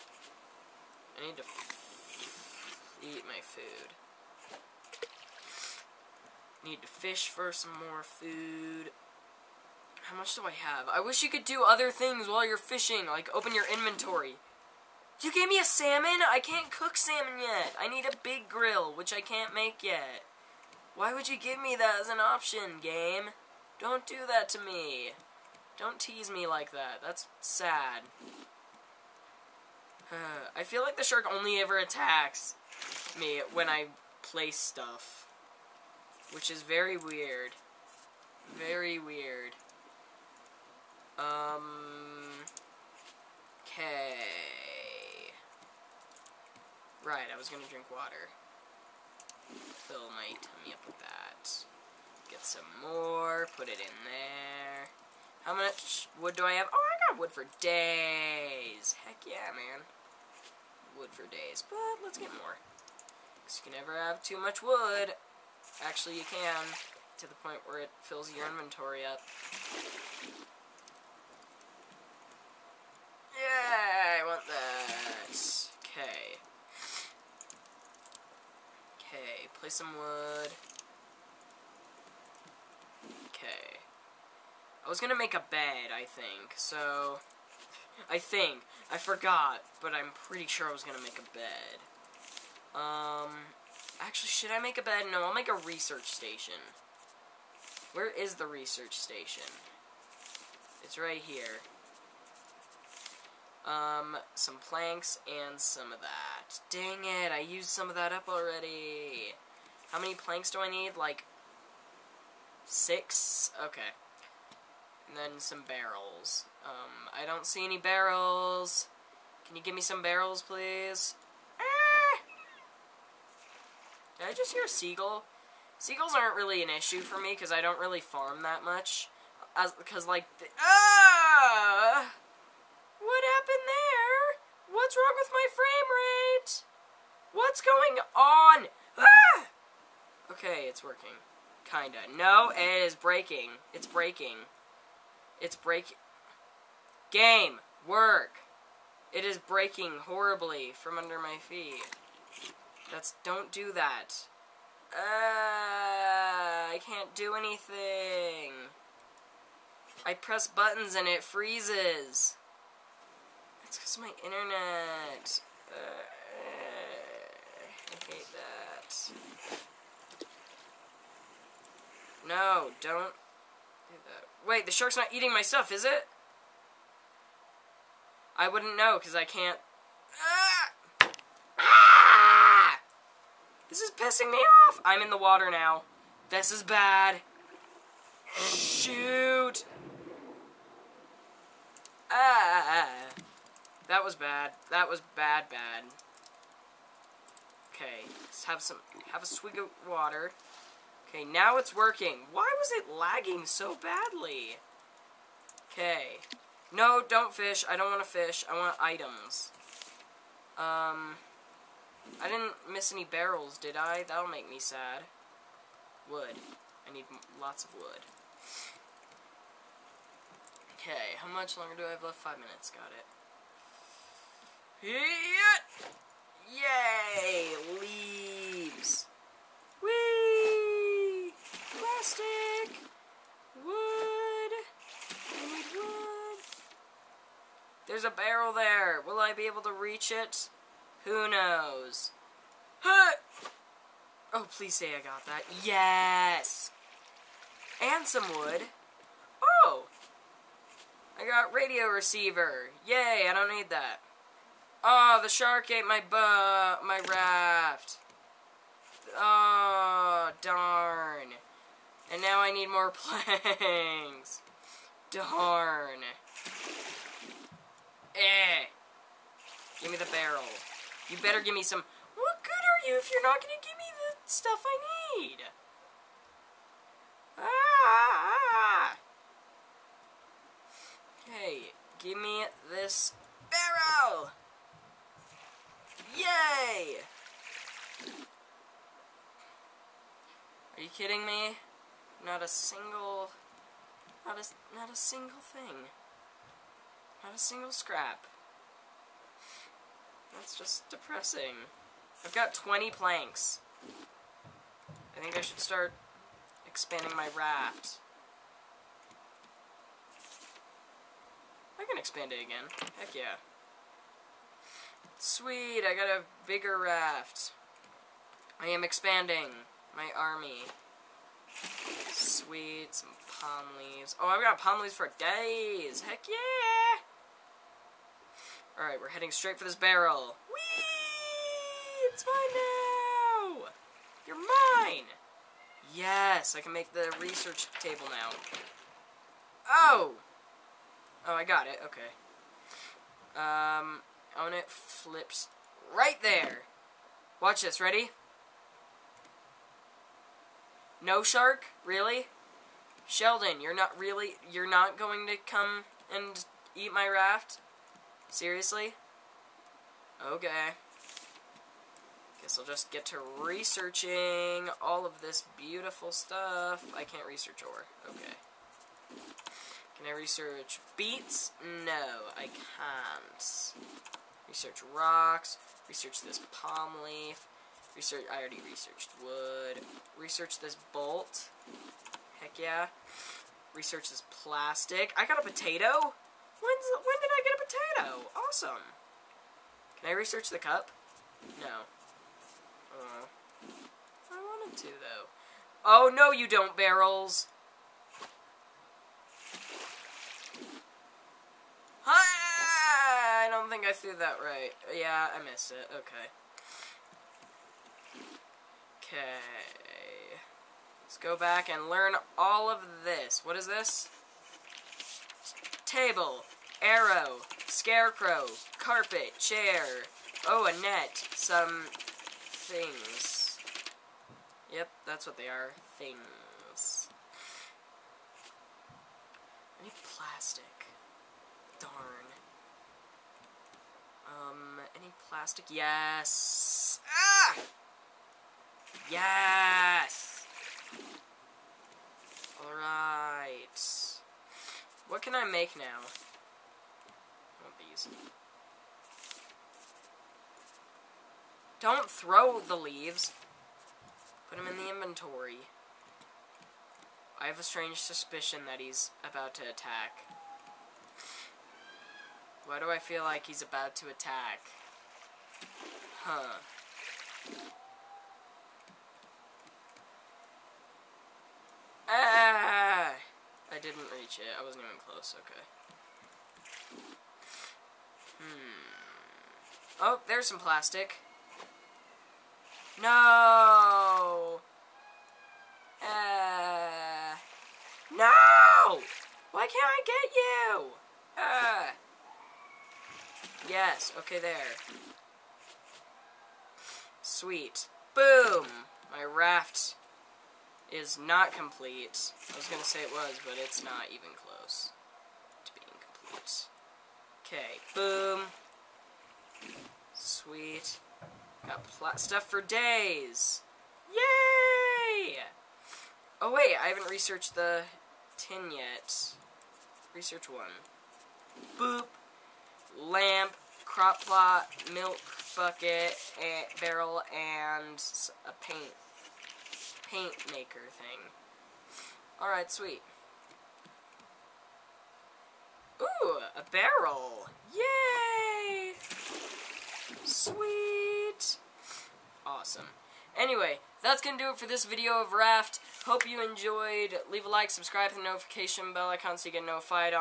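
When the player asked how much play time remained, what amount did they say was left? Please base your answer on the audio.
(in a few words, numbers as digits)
5 minutes.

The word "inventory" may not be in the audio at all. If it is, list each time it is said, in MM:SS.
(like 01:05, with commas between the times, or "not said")
00:13, 01:08, 07:34.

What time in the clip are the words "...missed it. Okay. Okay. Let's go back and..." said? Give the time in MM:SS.
06:45.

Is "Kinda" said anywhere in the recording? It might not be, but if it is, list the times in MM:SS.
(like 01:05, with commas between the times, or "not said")
02:21.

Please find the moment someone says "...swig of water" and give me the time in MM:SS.
03:19.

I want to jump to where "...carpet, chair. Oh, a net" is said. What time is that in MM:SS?
06:58.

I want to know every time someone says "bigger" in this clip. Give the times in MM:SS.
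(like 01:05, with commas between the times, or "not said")
05:16.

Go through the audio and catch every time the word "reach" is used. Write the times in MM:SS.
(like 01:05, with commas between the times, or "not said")
03:59, 07:54.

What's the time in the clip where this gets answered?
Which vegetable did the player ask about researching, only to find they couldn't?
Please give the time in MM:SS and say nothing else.
06:10.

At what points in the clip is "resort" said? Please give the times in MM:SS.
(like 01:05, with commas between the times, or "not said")
not said.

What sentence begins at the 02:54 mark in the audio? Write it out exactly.
Wait, the shark's not eating my stuff, is it?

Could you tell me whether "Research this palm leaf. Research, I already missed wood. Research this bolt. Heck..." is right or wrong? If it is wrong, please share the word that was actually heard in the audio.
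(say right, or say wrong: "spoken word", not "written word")
wrong: "researched", not "missed".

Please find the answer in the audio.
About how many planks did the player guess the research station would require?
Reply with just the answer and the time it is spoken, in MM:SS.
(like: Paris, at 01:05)
6, at 01:52.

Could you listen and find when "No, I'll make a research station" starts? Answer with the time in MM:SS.
01:35.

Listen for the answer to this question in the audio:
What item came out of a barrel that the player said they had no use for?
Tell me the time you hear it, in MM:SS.
04:11.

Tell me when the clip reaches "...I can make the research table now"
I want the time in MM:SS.
05:36.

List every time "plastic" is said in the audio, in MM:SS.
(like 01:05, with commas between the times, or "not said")
03:51, 06:24, 07:10, 07:15, 08:00.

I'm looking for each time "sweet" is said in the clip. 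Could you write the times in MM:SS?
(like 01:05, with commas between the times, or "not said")
05:15, 05:22, 08:17, 08:30, 08:52, 09:00.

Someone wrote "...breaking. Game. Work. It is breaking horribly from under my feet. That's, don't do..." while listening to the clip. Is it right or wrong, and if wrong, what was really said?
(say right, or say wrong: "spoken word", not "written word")
right.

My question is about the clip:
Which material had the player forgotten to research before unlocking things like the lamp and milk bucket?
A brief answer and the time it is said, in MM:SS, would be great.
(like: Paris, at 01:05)
tin, at 08:38.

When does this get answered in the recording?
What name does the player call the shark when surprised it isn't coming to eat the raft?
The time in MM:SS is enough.
05:53.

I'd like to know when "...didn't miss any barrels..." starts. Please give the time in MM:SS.
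03:32.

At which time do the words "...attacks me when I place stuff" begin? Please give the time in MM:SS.
00:31.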